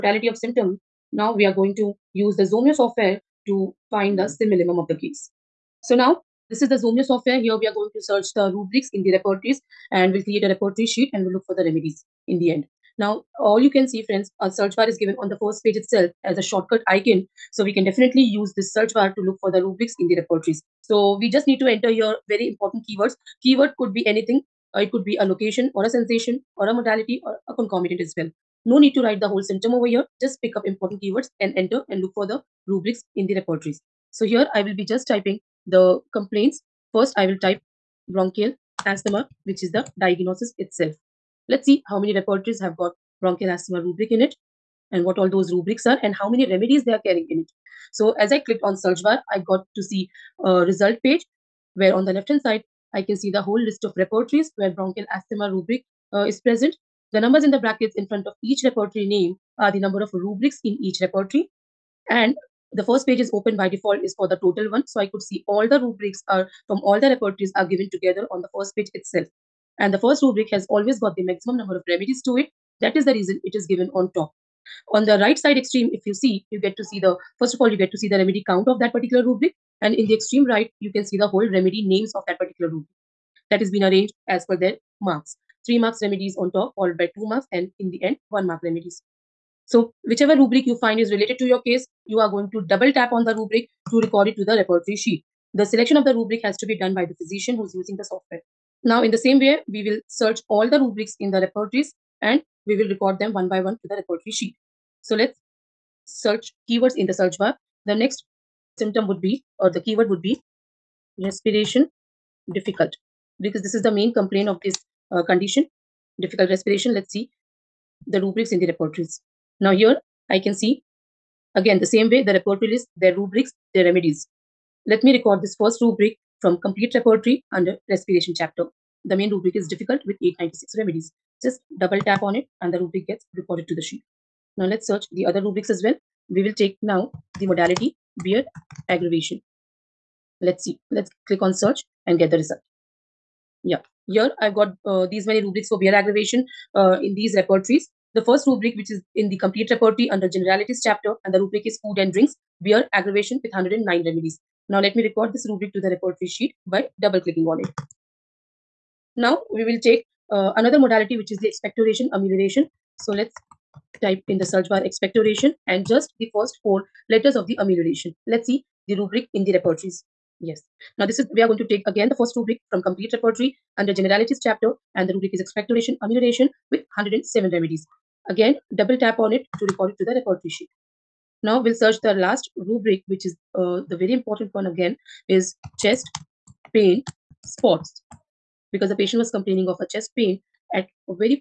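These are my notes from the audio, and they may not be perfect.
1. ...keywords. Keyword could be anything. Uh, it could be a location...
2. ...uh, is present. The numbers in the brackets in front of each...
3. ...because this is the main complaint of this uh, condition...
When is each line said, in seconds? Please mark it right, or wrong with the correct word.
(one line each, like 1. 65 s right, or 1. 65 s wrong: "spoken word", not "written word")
1. 22 s right
2. 56 s right
3. 113 s right.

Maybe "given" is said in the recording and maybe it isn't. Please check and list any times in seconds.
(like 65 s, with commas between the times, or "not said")
14 s, 67 s, 73 s.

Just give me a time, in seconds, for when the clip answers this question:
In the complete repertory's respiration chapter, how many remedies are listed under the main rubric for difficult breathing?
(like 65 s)
130 s.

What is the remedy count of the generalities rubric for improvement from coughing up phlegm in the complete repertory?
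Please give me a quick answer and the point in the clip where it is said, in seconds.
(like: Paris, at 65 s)
107, at 176 s.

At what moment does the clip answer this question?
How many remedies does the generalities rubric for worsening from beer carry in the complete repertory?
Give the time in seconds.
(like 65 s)
153 s.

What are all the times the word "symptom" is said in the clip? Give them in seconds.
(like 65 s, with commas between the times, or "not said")
0 s, 29 s, 108 s.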